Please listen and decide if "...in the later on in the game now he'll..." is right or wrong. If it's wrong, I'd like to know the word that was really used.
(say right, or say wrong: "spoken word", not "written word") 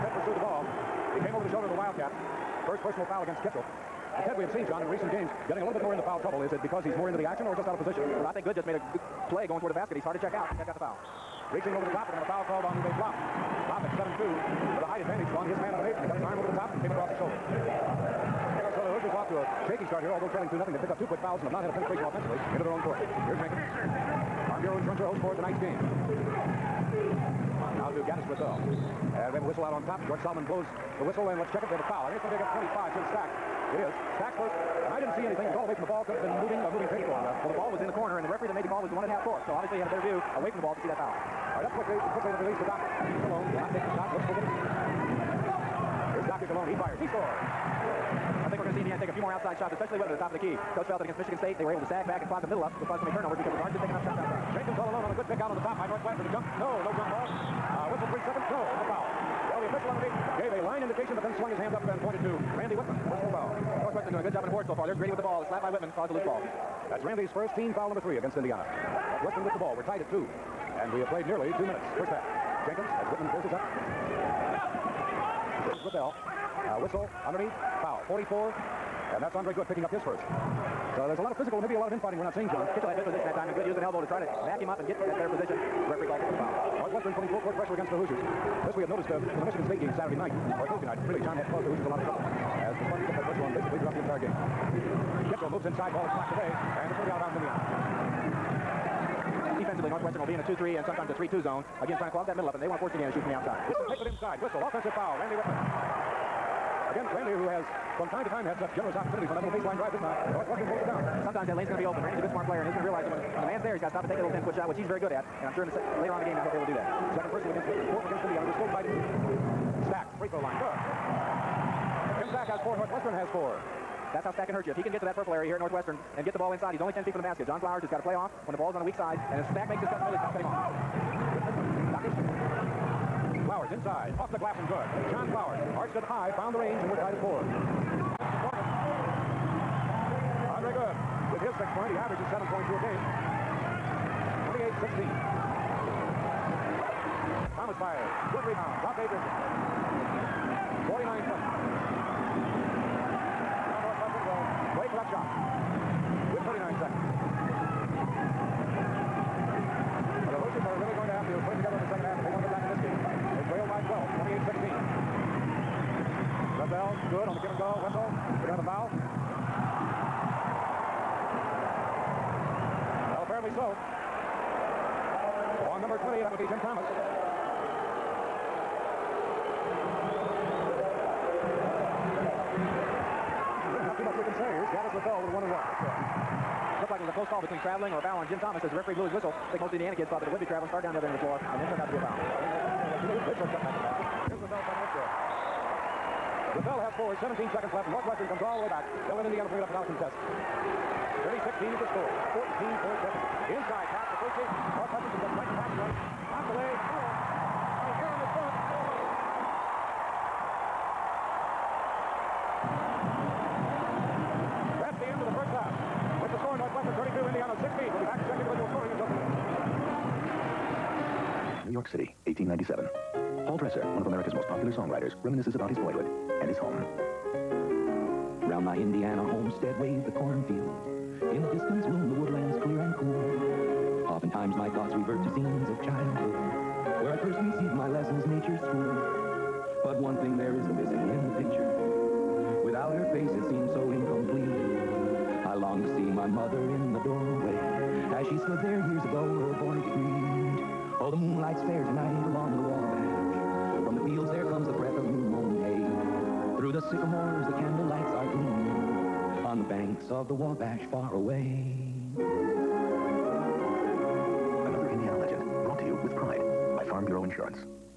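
right.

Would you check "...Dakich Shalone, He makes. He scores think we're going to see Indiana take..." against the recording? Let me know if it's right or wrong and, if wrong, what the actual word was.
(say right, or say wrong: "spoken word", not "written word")
wrong: "fires", not "makes".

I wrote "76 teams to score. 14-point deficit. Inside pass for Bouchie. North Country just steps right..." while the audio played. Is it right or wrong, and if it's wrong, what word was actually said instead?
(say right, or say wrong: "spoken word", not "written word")
wrong: "36", not "76".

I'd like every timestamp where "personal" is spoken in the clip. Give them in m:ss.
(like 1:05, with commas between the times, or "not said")
0:02, 1:03, 1:57.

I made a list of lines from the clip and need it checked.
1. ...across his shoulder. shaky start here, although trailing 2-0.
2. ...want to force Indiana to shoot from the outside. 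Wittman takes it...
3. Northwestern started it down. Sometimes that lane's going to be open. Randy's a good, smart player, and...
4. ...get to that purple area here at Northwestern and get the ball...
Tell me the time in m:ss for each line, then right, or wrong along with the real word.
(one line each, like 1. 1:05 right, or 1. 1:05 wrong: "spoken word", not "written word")
1. 0:16 right
2. 1:42 right
3. 1:50 wrong: "closed", not "started"
4. 2:04 right.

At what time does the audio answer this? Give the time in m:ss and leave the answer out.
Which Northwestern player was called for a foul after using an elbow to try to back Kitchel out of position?
1:19.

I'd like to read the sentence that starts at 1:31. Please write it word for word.
Really, John had caused the Hoosiers a lot of trouble.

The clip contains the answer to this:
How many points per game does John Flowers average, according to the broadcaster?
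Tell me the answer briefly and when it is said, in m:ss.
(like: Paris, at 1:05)
7.2, at 2:22.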